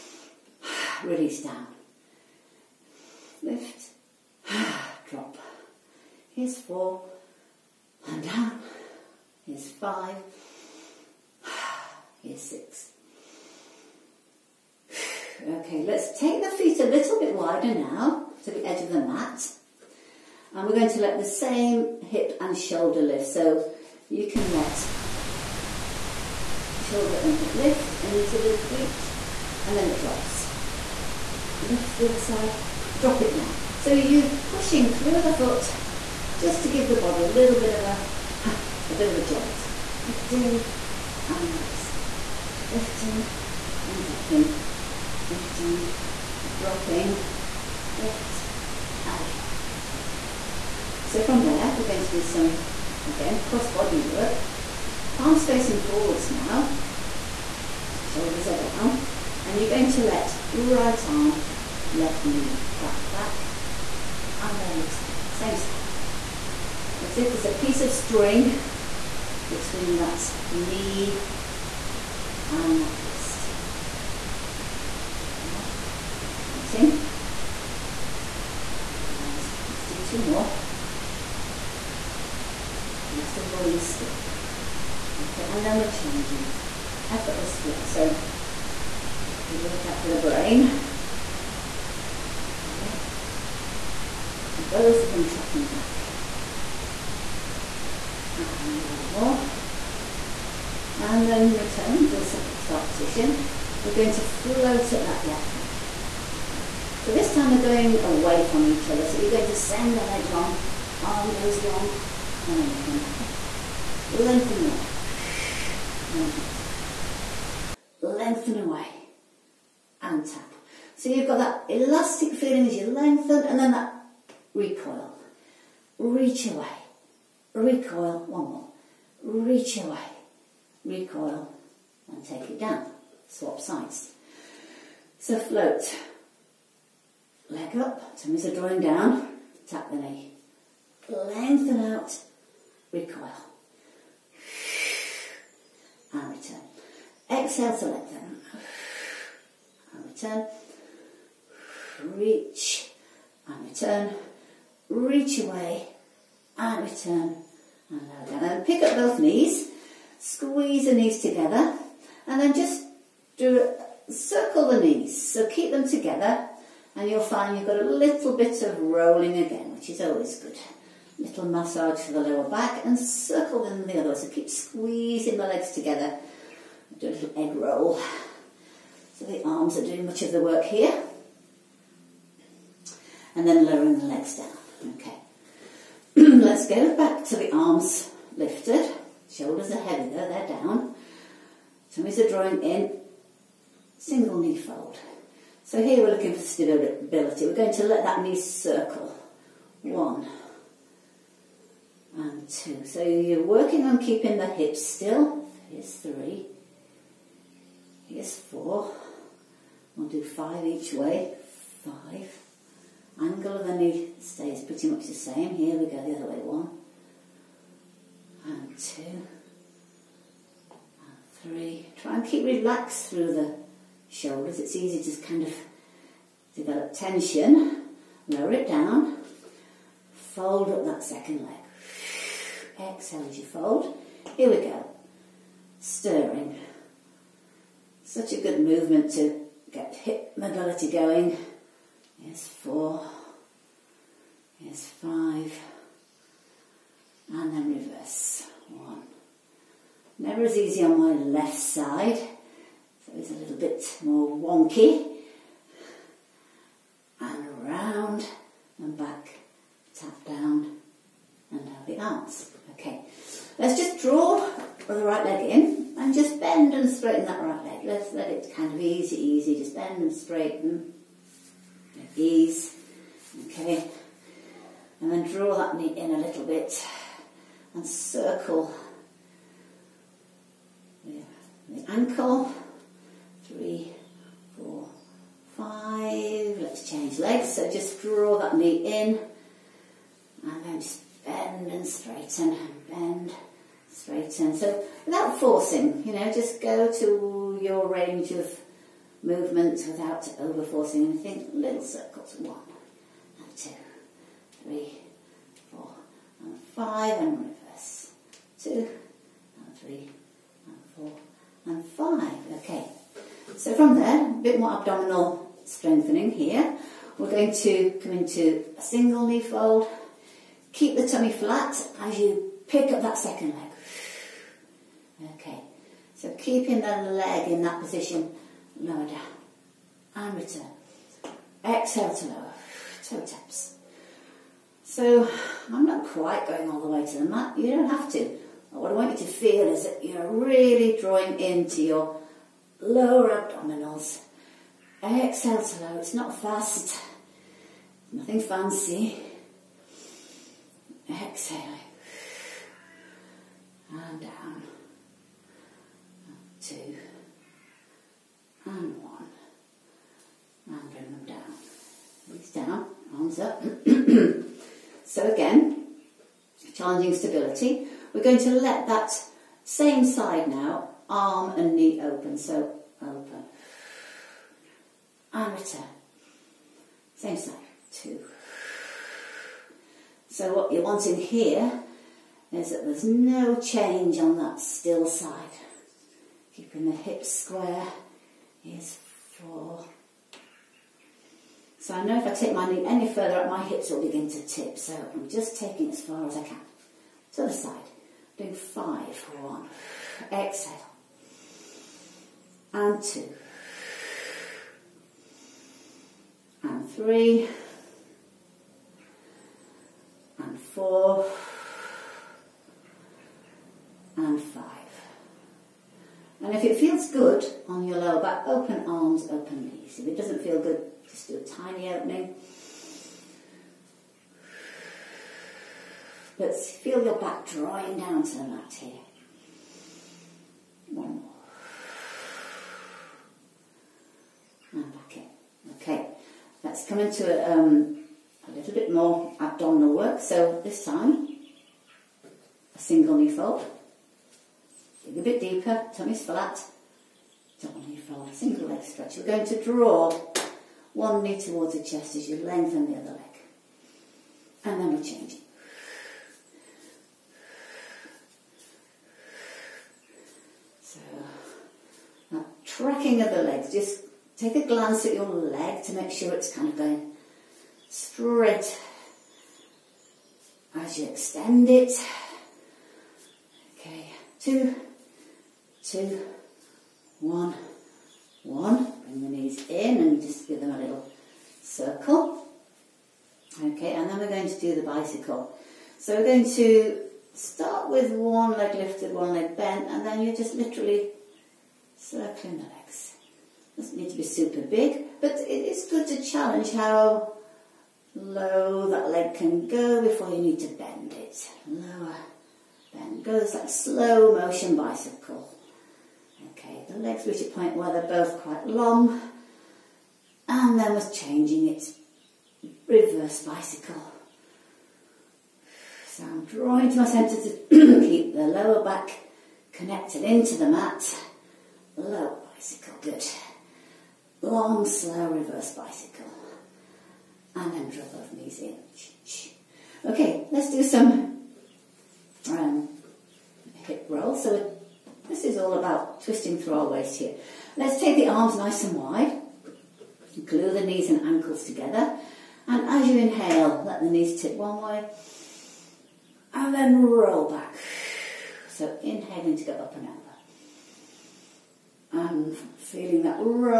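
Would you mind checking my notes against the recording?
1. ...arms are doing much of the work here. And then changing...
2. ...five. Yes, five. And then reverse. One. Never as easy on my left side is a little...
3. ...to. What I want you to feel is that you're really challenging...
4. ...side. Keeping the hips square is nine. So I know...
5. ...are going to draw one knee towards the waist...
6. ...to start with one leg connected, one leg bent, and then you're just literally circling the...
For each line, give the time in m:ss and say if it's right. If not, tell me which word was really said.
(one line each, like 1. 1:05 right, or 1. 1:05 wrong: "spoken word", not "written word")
1. 2:59 wrong: "lowering", not "changing"
2. 4:02 wrong: "four", not "five"
3. 5:38 wrong: "drawing", not "challenging"
4. 6:25 wrong: "four", not "nine"
5. 7:29 wrong: "chest", not "waist"
6. 8:06 wrong: "lifted", not "connected".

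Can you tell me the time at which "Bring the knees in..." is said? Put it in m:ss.
7:59.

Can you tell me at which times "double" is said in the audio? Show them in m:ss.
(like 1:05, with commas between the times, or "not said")
7:27.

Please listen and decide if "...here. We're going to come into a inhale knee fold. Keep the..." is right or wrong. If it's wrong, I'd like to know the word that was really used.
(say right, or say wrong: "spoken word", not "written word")
wrong: "single", not "inhale".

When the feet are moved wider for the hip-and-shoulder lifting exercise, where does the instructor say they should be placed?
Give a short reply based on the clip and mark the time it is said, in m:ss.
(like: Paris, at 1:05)
edge of the mat, at 0:18.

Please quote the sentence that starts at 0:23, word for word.
So you can let shoulder and hip lift and use a little reach and then it drops.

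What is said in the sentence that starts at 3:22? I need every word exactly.
So you're working on keeping the hips still.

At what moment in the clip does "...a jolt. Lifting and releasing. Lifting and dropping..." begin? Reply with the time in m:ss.
0:39.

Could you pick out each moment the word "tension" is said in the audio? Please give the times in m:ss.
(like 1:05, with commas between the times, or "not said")
3:46.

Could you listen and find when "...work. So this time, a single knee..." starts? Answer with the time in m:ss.
7:19.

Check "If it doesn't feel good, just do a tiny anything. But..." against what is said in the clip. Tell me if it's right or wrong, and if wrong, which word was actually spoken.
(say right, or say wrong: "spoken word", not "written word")
wrong: "opening", not "anything".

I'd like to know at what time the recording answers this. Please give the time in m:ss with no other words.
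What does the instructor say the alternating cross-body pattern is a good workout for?
1:30.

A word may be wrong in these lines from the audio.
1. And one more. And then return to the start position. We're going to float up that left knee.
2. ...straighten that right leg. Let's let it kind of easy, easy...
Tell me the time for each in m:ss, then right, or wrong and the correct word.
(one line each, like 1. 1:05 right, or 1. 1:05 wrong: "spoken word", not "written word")
1. 1:38 right
2. 4:26 right.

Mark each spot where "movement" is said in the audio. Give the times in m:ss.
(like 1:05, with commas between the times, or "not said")
3:58, 4:59.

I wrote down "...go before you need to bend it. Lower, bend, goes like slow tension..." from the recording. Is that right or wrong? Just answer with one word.
wrong.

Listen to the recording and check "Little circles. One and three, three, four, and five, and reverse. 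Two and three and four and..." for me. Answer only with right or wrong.
wrong.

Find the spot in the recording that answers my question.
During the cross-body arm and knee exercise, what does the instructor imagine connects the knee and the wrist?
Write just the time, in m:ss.
1:07.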